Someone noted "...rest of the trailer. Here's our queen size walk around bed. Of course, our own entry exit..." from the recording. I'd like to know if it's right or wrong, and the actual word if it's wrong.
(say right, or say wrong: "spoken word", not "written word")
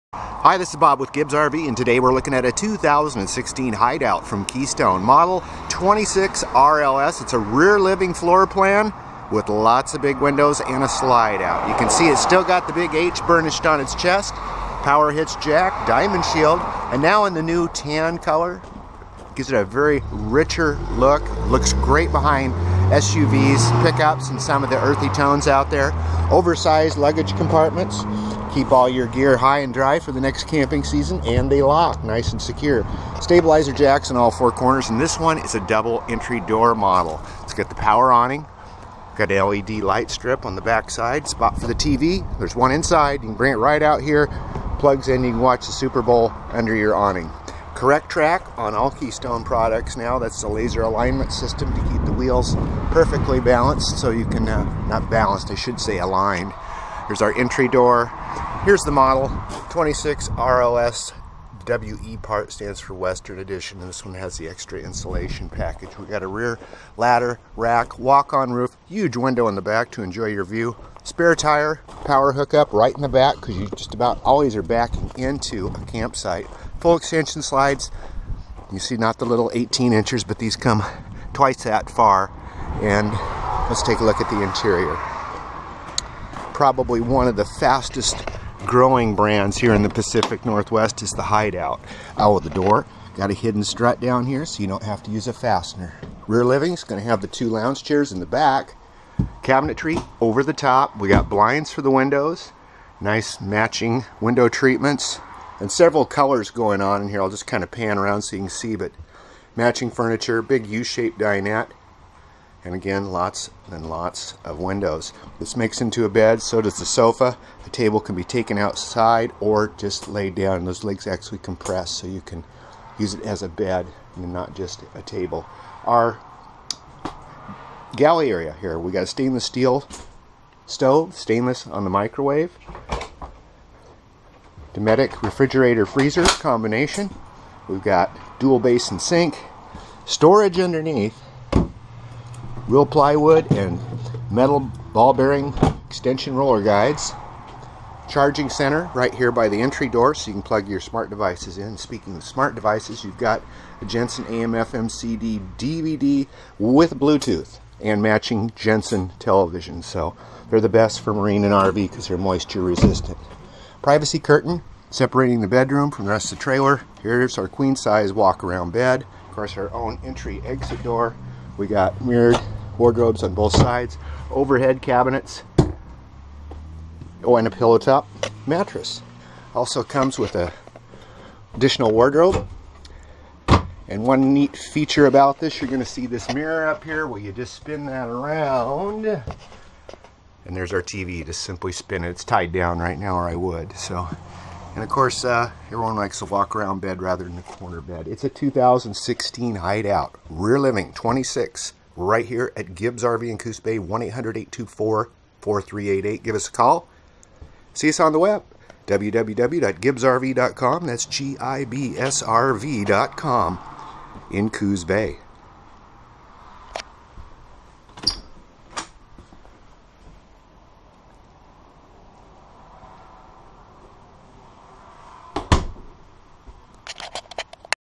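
right.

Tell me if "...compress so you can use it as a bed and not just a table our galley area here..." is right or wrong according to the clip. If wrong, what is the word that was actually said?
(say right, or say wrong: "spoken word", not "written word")
right.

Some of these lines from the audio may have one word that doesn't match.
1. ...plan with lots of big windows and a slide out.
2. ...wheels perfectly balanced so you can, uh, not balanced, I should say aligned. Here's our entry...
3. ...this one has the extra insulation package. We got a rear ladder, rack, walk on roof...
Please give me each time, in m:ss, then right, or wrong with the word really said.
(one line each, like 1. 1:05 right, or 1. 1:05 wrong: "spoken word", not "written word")
1. 0:08 right
2. 0:52 right
3. 1:03 right.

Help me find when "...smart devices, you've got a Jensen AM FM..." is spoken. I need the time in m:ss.
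2:32.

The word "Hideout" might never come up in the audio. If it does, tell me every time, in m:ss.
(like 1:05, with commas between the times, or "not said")
0:03, 1:31, 3:19.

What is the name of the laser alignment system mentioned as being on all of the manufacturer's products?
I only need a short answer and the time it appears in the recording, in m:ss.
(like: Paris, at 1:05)
CorrecTrack, at 0:47.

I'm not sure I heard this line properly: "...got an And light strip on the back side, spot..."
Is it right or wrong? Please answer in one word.
wrong.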